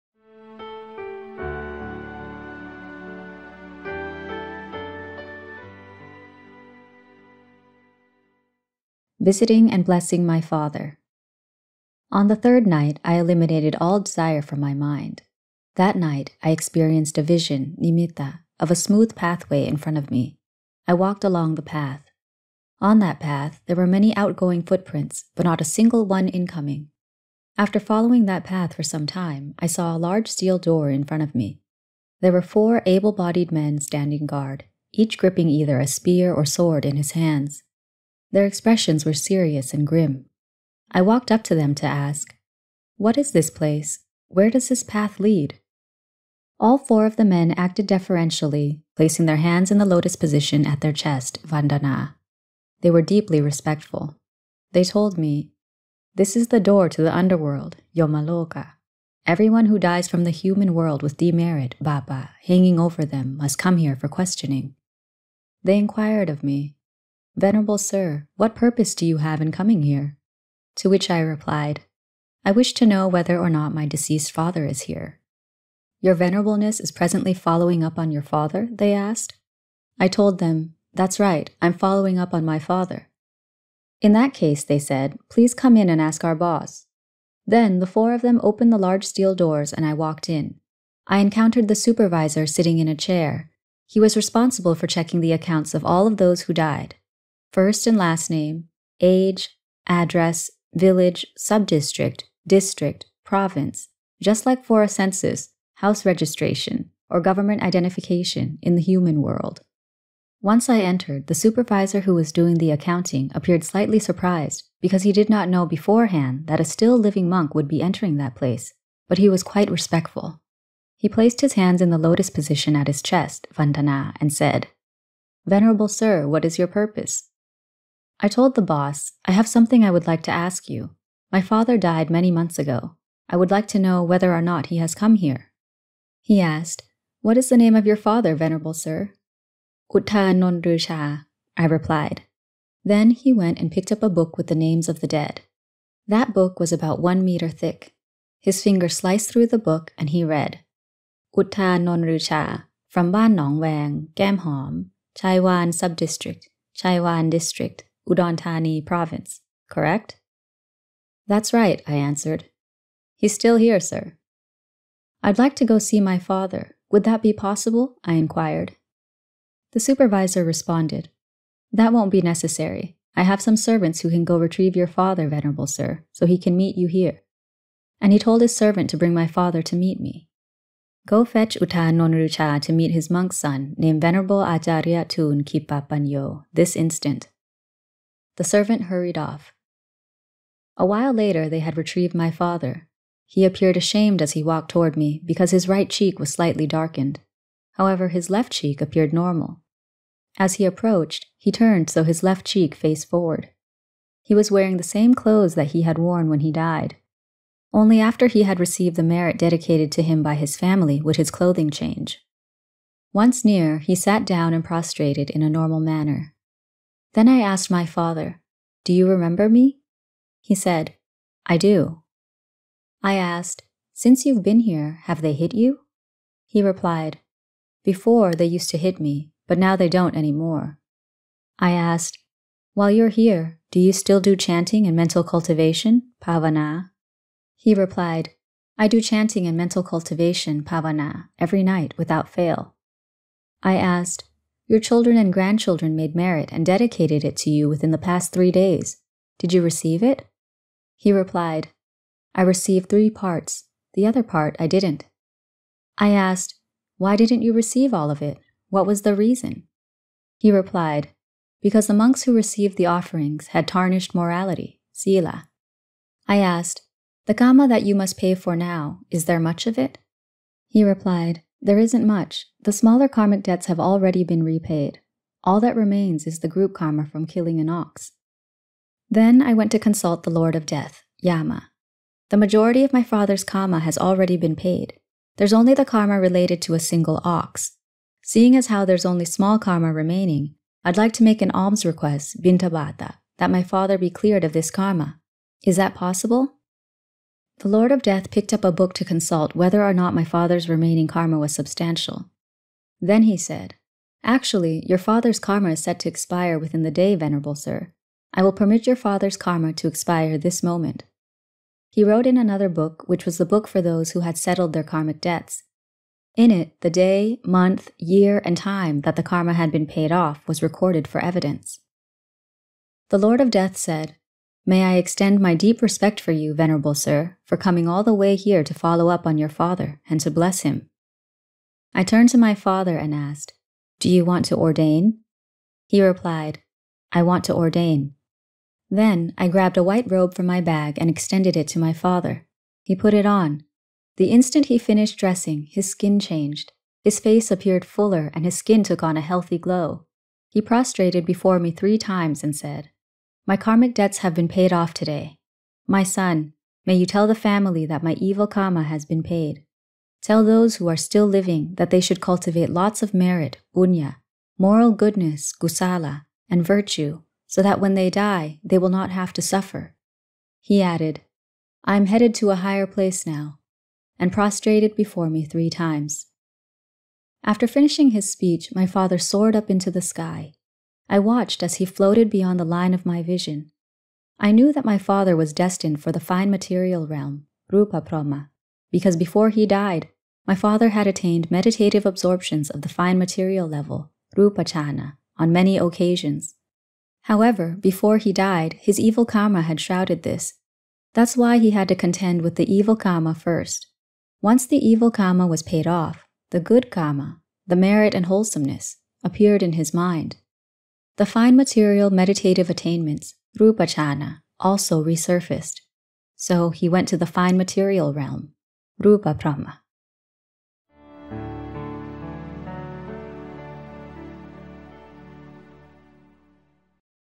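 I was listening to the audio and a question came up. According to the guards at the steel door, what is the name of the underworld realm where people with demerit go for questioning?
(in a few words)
Yomaloka.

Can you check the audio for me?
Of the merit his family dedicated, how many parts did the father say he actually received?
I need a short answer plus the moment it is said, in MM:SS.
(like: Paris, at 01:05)
3, at 04:12.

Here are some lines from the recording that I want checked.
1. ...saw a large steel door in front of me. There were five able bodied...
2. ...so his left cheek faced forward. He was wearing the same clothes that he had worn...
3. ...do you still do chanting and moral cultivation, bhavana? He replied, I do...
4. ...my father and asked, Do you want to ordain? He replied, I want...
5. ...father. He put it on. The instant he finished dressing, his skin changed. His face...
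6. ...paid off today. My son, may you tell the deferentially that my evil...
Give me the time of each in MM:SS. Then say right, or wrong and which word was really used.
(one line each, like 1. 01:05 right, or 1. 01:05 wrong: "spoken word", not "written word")
1. 00:29 wrong: "four", not "five"
2. 03:21 right
3. 03:53 wrong: "mental", not "moral"
4. 05:32 right
5. 05:41 right
6. 05:54 wrong: "family", not "deferentially".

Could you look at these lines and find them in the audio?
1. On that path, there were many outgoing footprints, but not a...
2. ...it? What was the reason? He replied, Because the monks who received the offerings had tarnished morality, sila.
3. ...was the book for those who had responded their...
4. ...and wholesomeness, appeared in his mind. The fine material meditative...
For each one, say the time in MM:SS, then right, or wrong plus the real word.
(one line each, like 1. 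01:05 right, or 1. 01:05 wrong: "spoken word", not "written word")
1. 00:22 right
2. 04:18 right
3. 05:13 wrong: "settled", not "responded"
4. 06:48 right.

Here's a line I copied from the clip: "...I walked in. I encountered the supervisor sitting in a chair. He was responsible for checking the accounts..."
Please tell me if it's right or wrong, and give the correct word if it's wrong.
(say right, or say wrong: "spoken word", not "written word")
right.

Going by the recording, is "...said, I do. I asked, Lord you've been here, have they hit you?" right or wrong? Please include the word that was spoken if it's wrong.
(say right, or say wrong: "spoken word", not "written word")
wrong: "Since", not "Lord".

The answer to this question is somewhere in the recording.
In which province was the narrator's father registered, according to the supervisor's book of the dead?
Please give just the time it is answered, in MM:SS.
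02:38.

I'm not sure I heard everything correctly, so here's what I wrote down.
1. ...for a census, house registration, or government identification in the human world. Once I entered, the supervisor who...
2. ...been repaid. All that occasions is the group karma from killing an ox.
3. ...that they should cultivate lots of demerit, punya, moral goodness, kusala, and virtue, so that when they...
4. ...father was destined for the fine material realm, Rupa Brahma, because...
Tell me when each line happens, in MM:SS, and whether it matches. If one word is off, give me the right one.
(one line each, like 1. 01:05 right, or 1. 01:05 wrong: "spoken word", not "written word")
1. 01:44 right
2. 04:34 wrong: "remains", not "occasions"
3. 06:01 wrong: "merit", not "demerit"
4. 06:24 right.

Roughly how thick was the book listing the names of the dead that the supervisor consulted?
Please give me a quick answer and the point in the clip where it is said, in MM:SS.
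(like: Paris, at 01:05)
1 meter, at 02:26.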